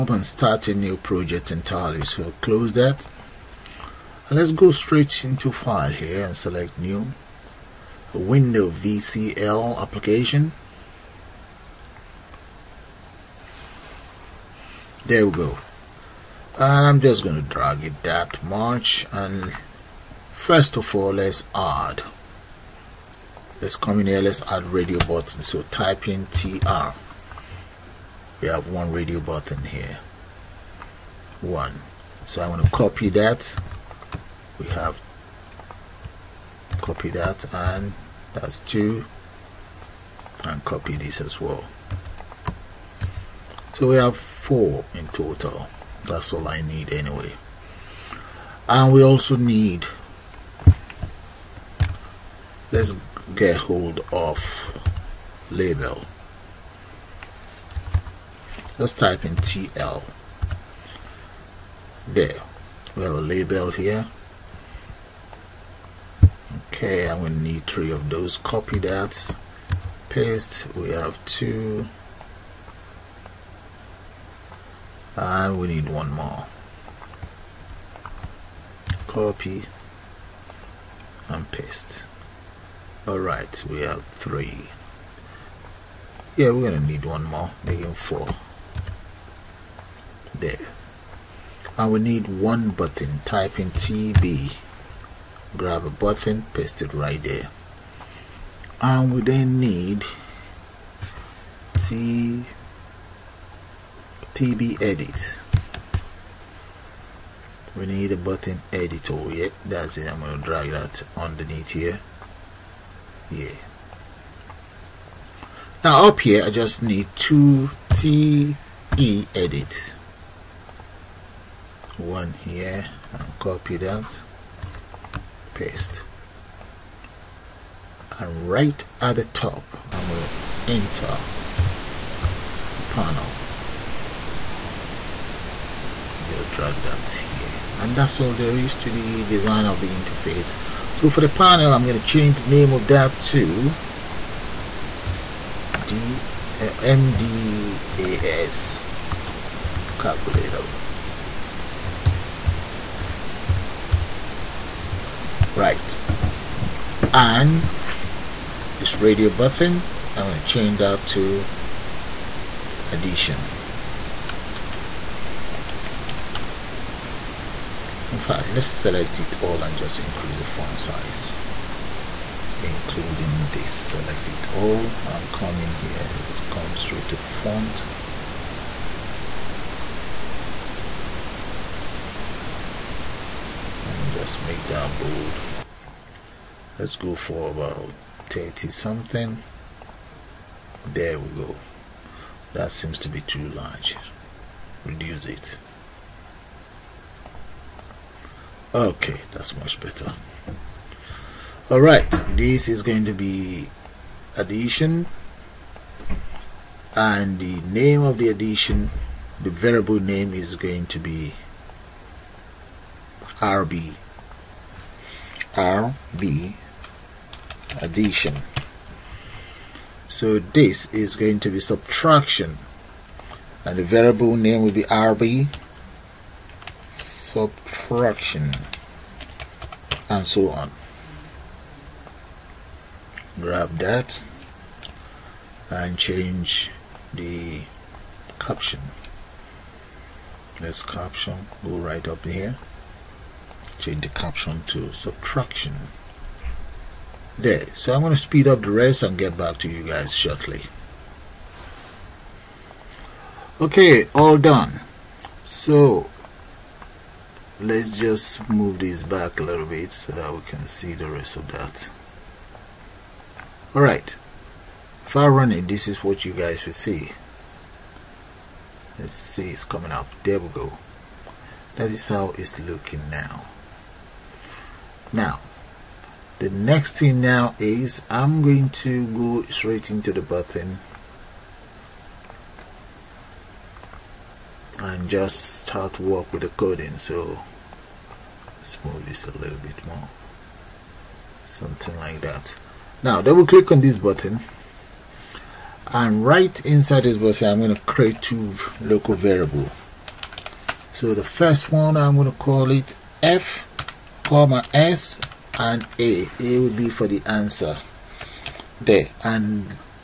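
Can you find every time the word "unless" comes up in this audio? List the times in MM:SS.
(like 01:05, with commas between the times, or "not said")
not said.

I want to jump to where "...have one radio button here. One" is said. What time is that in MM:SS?
00:28.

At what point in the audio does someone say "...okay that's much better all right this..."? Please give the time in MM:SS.
03:18.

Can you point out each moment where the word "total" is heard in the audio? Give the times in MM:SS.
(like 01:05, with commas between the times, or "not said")
00:45.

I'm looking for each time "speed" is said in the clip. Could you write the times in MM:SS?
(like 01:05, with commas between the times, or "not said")
04:08.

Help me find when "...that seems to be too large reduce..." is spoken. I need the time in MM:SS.
03:12.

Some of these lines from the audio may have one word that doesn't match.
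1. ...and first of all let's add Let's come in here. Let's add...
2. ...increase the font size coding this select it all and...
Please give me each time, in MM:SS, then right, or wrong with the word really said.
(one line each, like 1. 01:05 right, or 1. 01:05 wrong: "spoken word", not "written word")
1. 00:19 right
2. 02:49 wrong: "including", not "coding".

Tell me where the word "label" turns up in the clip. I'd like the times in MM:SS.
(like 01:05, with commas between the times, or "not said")
00:55, 01:03.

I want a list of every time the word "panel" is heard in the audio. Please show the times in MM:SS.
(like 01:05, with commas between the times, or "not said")
02:12, 02:21.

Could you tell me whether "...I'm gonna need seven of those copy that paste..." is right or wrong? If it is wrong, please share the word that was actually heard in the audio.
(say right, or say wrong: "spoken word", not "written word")
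wrong: "three", not "seven".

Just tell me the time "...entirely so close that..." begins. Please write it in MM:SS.
00:01.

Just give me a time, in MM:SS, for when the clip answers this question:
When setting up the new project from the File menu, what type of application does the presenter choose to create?
00:08.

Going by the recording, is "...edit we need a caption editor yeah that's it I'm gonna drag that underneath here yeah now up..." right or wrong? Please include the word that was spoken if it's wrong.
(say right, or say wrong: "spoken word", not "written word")
wrong: "button", not "caption".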